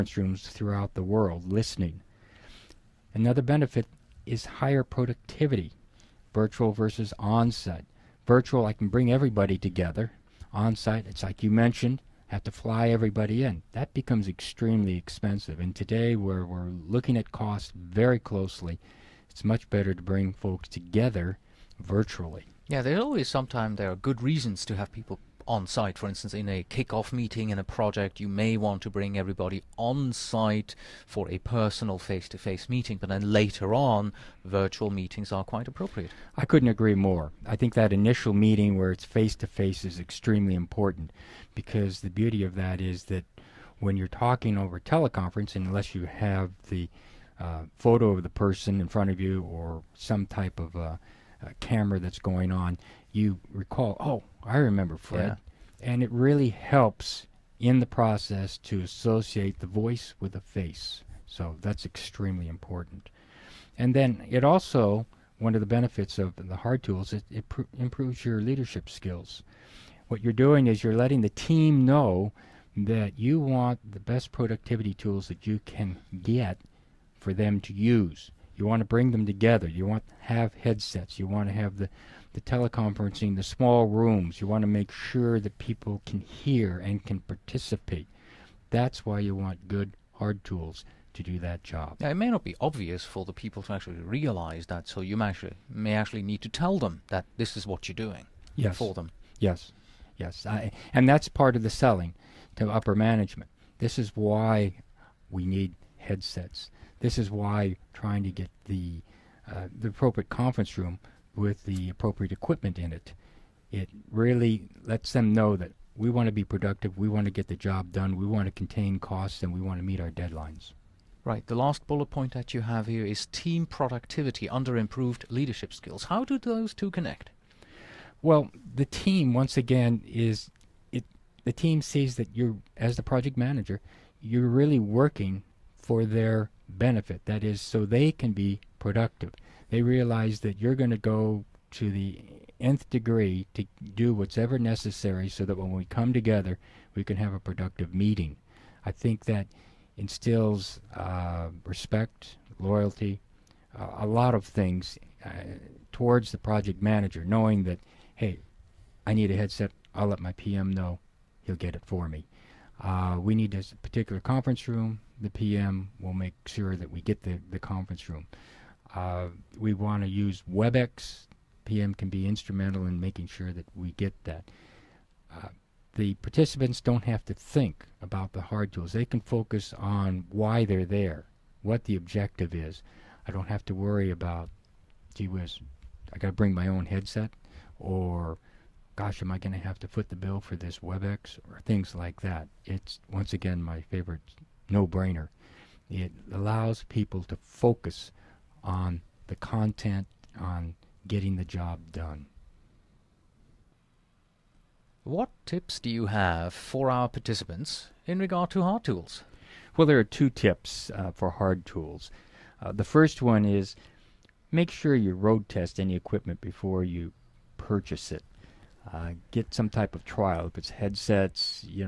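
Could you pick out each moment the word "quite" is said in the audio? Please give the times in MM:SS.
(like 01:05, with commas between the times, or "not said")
00:35.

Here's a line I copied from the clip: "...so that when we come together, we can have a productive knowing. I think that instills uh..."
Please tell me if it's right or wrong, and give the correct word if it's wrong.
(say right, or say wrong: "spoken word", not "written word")
wrong: "meeting", not "knowing".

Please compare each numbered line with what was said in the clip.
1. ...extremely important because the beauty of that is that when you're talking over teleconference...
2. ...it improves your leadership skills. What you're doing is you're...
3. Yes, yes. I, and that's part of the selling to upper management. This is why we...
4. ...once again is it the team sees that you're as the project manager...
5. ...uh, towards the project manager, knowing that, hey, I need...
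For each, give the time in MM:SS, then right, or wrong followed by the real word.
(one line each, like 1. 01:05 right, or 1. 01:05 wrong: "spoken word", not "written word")
1. 00:39 right
2. 01:07 right
3. 01:39 right
4. 02:09 right
5. 02:35 right.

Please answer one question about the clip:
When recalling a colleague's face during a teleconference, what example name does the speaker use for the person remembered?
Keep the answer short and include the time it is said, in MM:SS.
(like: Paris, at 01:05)
Fred, at 00:54.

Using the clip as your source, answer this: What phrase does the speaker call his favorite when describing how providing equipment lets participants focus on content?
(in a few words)
no-brainer.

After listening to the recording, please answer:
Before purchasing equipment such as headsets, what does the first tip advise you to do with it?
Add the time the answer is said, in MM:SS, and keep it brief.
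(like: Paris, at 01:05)
road test, at 03:35.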